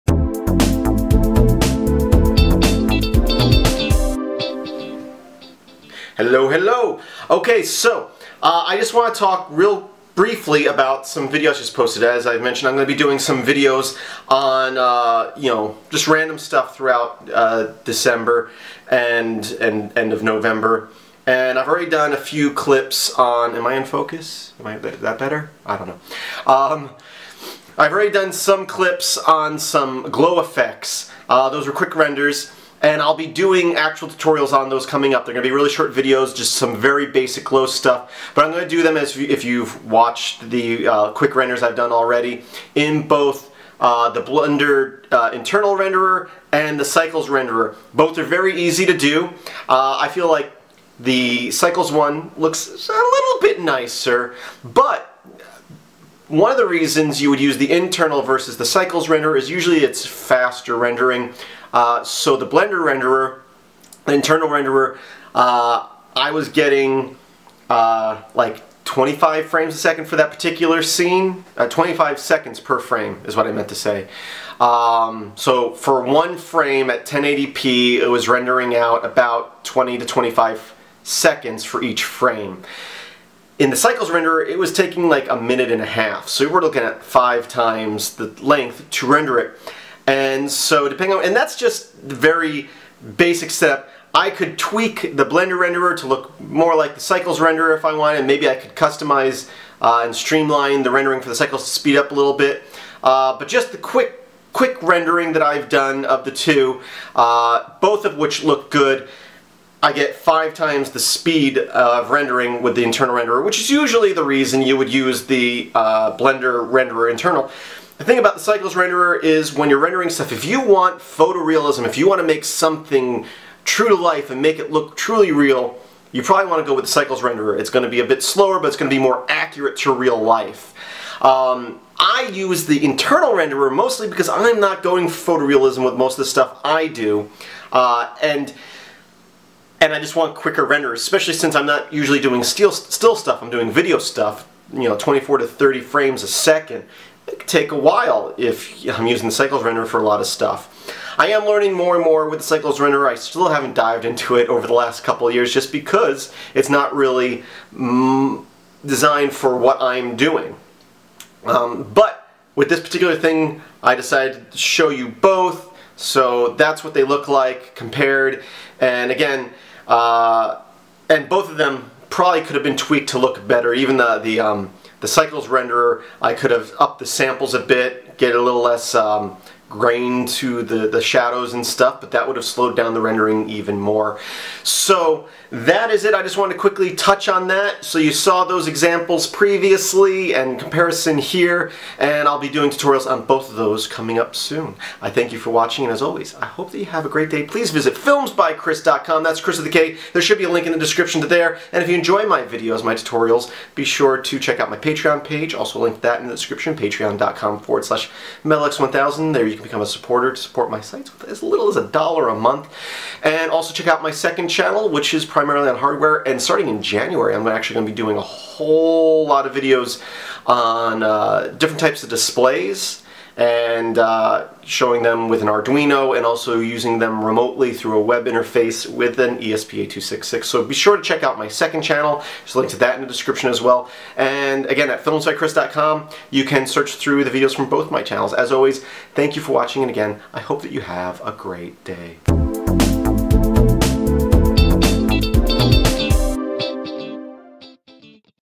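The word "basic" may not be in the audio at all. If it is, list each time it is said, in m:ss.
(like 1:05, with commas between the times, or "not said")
0:37, 1:33.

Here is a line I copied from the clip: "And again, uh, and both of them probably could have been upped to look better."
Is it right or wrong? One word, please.
wrong.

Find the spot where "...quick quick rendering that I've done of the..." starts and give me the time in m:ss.
1:43.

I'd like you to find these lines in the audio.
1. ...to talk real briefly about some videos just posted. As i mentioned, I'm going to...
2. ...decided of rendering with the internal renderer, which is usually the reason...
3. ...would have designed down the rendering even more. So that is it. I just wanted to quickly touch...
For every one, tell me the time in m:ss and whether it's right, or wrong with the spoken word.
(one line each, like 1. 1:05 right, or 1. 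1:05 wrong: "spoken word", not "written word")
1. 0:09 right
2. 1:50 wrong: "speed", not "decided"
3. 3:02 wrong: "slowed", not "designed".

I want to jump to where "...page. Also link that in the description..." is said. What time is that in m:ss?
3:25.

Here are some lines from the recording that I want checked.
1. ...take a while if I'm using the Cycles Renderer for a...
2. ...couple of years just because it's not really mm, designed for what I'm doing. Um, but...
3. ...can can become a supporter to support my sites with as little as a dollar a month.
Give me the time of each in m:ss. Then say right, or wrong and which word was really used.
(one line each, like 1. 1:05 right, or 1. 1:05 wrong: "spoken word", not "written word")
1. 2:27 right
2. 2:35 right
3. 3:29 right.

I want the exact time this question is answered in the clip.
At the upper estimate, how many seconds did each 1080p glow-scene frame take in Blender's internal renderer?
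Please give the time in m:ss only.
1:19.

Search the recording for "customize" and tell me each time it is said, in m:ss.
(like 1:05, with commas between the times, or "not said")
1:38.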